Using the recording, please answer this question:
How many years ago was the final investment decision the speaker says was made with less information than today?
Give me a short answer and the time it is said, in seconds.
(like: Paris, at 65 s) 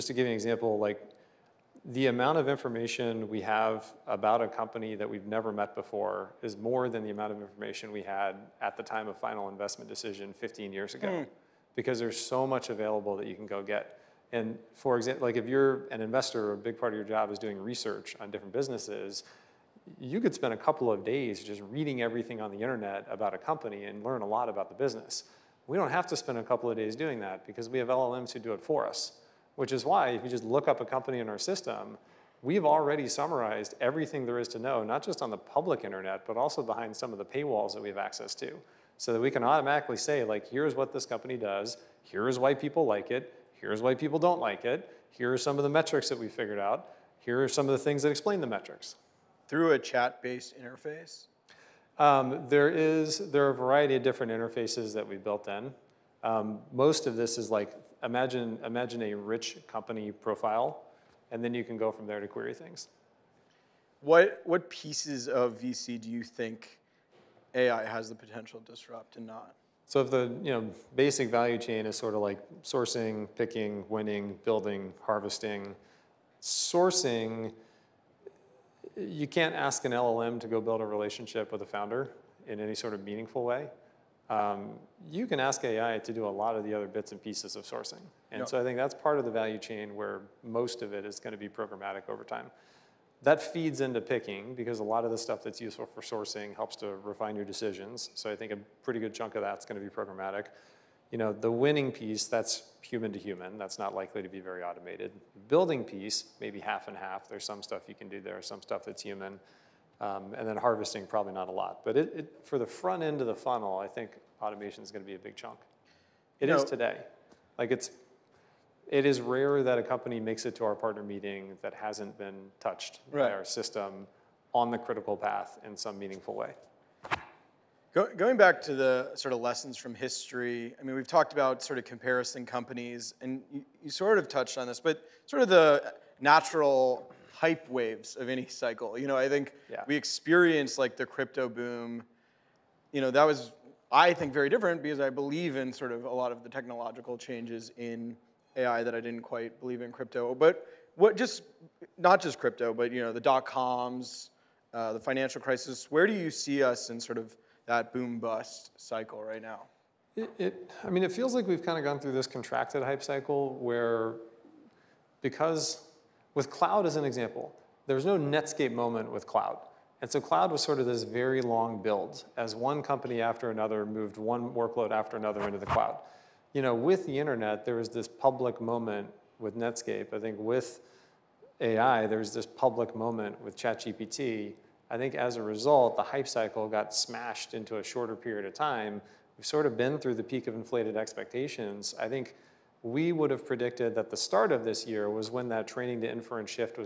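15 years, at 10 s.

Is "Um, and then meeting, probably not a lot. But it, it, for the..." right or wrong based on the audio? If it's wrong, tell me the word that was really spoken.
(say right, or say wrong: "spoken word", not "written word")
wrong: "harvesting", not "meeting".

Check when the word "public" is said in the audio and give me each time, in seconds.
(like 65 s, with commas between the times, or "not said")
35 s, 178 s, 182 s.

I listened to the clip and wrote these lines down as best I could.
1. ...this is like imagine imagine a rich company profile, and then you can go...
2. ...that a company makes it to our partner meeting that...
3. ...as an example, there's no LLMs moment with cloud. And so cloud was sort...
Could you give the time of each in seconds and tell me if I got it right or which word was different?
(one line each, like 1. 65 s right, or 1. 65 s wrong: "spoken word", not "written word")
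1. 57 s right
2. 119 s right
3. 166 s wrong: "Netscape", not "LLMs".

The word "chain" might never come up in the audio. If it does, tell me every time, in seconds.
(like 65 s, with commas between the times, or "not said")
71 s, 89 s.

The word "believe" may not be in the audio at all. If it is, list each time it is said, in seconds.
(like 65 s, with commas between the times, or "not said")
145 s, 149 s.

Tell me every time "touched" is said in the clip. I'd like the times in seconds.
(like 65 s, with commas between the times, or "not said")
122 s, 134 s.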